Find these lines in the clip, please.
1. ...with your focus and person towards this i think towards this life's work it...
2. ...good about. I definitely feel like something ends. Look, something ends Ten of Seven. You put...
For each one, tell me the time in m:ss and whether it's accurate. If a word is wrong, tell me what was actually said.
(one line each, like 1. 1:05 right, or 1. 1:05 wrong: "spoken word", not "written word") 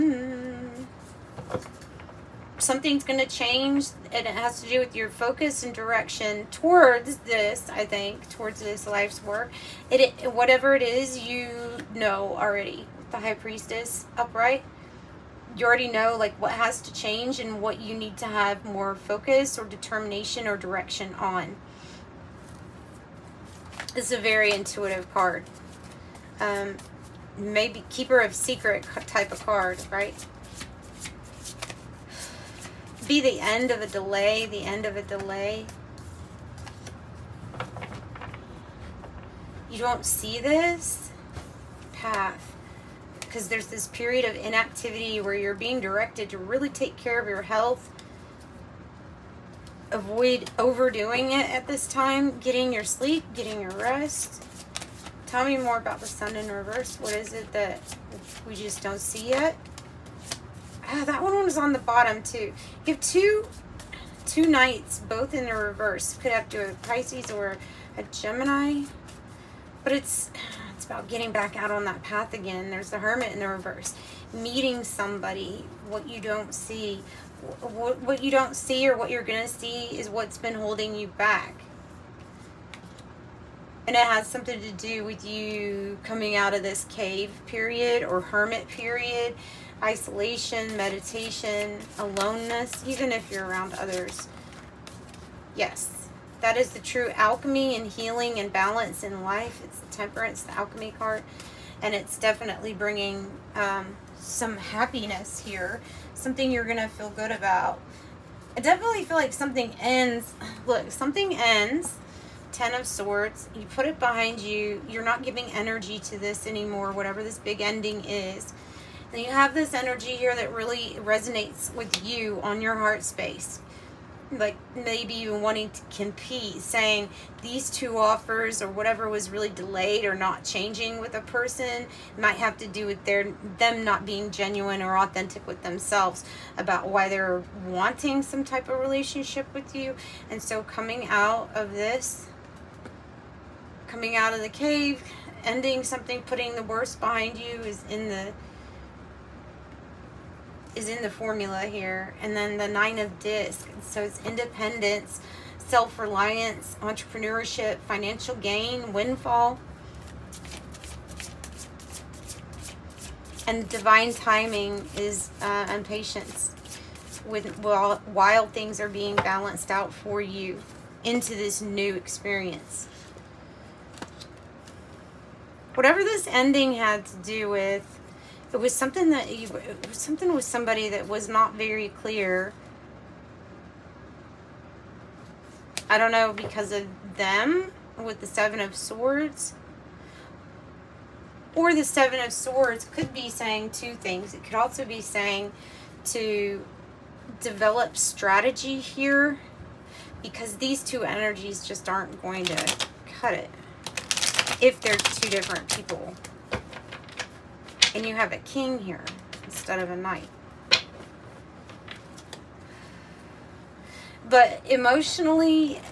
1. 0:04 wrong: "direction", not "person"
2. 1:47 wrong: "Swords", not "Seven".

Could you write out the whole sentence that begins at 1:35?
Yes, that is the true alchemy and healing and balance in life.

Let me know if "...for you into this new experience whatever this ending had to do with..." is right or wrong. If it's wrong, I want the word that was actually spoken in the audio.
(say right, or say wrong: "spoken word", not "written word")
right.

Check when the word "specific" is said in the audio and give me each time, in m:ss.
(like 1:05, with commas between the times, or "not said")
not said.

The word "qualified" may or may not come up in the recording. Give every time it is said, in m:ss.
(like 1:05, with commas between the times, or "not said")
not said.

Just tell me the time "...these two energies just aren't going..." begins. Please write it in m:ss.
3:20.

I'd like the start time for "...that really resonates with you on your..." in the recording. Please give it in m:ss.
2:00.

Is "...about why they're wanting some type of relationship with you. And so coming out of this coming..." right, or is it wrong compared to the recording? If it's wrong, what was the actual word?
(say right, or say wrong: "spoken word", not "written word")
right.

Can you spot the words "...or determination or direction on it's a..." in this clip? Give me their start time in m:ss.
0:19.